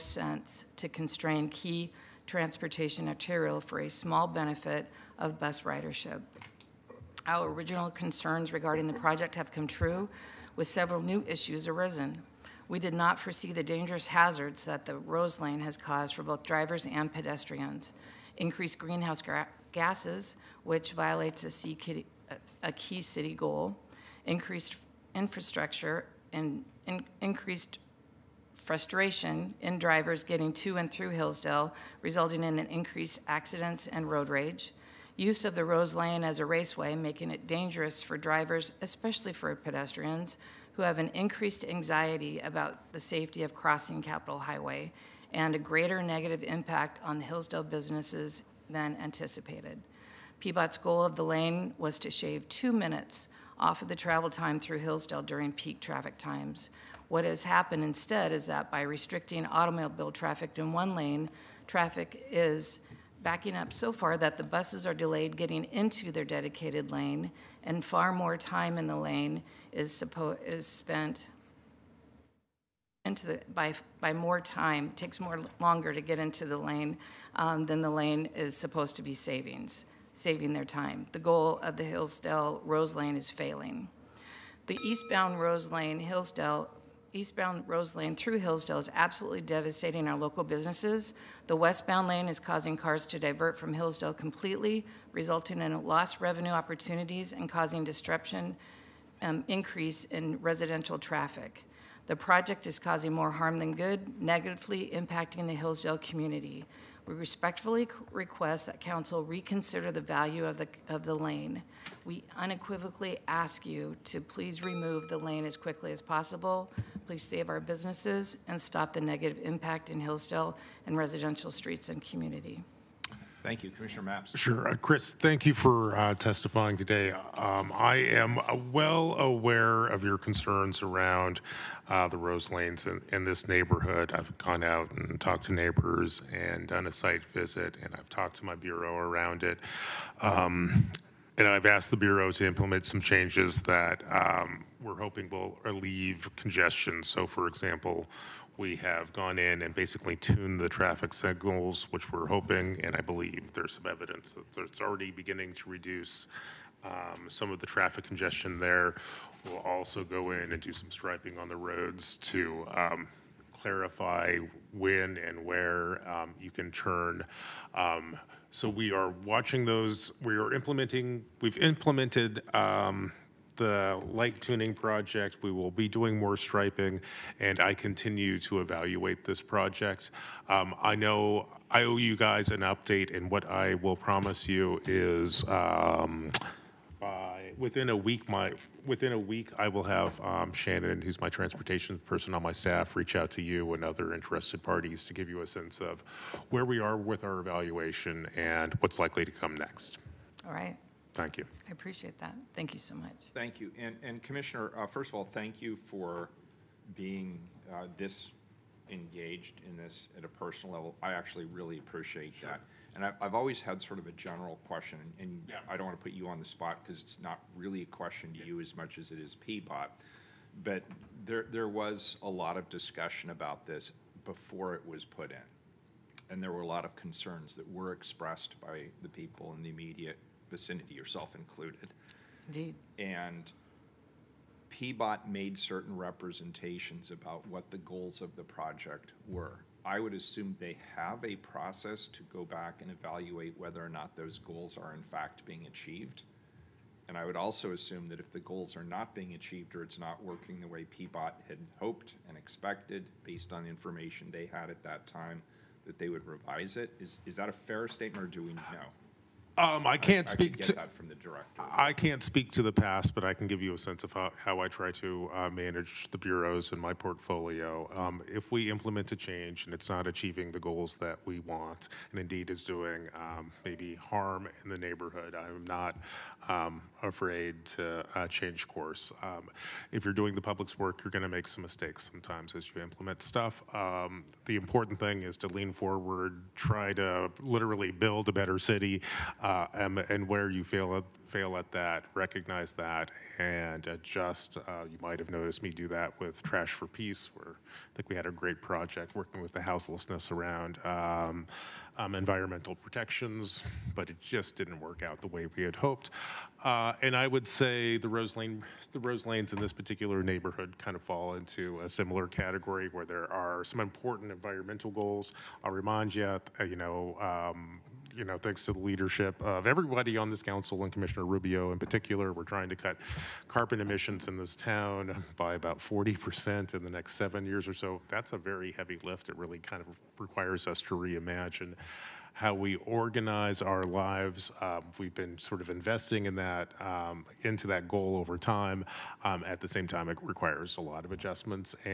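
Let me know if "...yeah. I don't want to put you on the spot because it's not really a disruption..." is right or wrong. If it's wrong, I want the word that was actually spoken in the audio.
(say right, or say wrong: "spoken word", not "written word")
wrong: "question", not "disruption".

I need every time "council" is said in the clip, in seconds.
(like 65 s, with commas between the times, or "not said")
108 s, 320 s.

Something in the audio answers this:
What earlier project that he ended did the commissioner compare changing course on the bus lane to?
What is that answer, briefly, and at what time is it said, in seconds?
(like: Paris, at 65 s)
Trash for Peace, at 296 s.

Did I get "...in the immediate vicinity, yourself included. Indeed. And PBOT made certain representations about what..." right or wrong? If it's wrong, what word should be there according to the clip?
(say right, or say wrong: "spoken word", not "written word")
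right.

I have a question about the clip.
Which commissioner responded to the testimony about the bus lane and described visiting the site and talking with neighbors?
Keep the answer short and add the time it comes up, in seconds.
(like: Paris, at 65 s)
Commissioner Mapps, at 123 s.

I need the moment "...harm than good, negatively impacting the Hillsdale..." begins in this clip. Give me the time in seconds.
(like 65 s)
103 s.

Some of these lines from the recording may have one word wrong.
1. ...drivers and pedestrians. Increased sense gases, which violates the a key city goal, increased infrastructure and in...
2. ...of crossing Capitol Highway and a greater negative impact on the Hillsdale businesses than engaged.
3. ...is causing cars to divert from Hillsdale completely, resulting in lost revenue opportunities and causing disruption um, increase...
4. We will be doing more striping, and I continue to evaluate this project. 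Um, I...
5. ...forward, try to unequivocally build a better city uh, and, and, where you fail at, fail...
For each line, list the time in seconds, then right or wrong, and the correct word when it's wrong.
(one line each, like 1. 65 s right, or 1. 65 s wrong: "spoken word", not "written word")
1. 16 s wrong: "greenhouse", not "sense"
2. 43 s wrong: "anticipated", not "engaged"
3. 92 s right
4. 175 s right
5. 285 s wrong: "literally", not "unequivocally".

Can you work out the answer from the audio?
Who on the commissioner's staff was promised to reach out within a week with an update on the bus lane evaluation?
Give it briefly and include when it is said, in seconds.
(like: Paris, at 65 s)
Shannon, at 190 s.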